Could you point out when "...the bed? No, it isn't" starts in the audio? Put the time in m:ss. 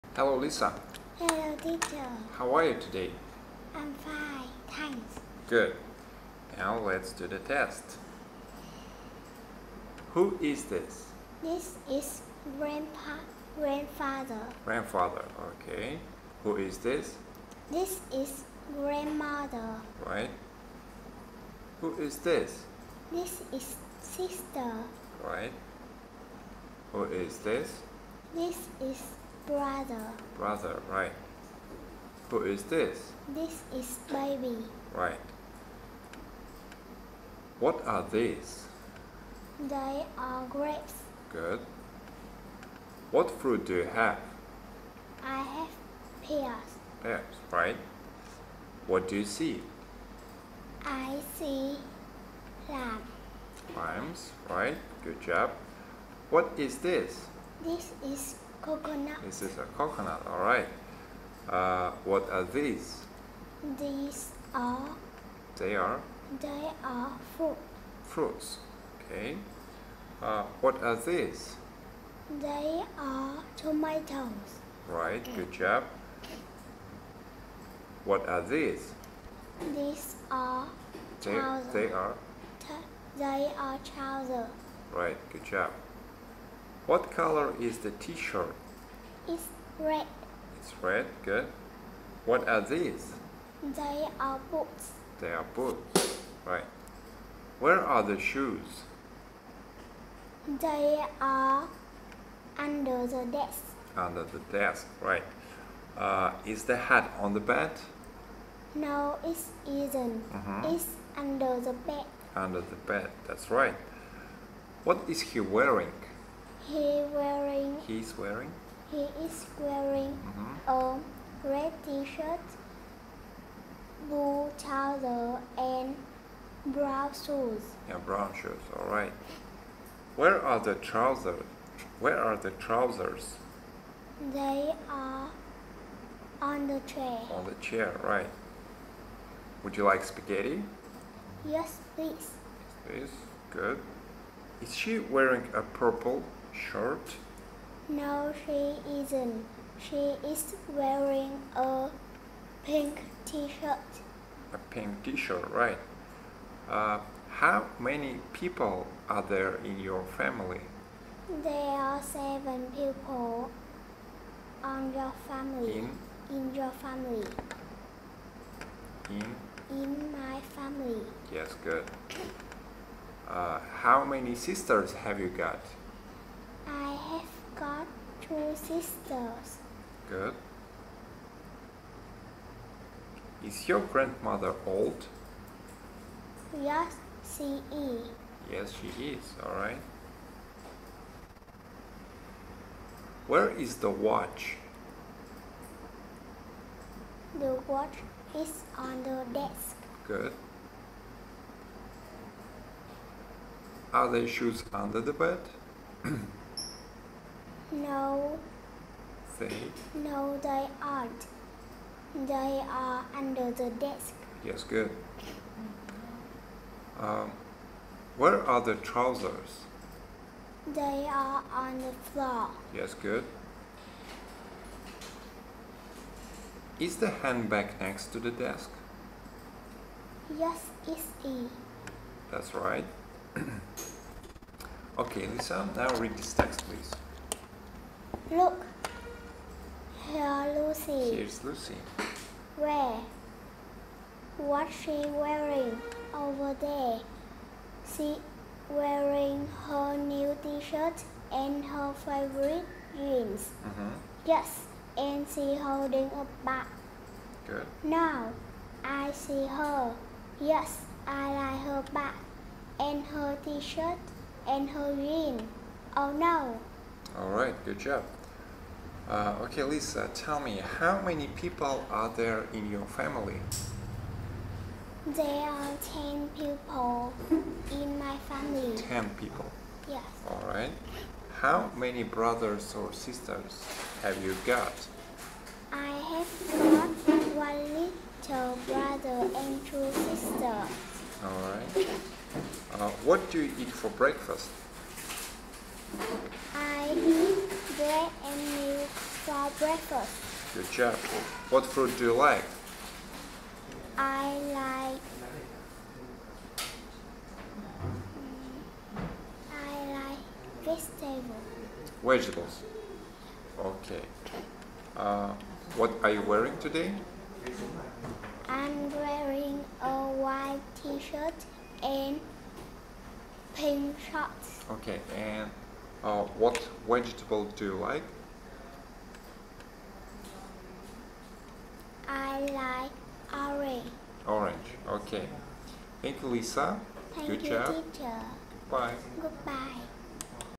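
1:47.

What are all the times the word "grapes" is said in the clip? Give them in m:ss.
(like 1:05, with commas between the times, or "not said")
0:40.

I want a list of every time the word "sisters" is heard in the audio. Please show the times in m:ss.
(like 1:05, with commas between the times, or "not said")
0:24, 2:54, 2:58, 4:42, 4:49.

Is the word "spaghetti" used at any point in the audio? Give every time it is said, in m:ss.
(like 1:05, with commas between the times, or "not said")
2:20.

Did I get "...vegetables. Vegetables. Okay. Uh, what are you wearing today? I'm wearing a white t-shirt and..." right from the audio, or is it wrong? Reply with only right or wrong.
right.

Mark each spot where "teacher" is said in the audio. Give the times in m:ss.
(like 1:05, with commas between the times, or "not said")
0:01, 5:37.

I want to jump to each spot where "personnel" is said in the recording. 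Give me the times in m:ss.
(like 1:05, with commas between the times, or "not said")
not said.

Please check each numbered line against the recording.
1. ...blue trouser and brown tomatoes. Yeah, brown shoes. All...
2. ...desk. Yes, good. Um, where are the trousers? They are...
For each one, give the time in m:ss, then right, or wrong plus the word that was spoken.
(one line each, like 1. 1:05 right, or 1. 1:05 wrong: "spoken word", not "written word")
1. 2:04 wrong: "shoes", not "tomatoes"
2. 3:33 right.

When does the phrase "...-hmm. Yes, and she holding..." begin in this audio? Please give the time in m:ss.
4:13.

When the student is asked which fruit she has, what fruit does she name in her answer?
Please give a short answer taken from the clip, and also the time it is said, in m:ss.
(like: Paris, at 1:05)
pears, at 0:45.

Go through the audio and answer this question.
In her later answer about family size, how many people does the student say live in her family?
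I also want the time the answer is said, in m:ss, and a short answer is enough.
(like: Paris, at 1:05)
10, at 4:35.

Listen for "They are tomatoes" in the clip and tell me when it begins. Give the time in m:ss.
1:12.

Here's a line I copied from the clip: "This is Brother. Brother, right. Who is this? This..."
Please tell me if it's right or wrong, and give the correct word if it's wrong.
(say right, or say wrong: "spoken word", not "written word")
right.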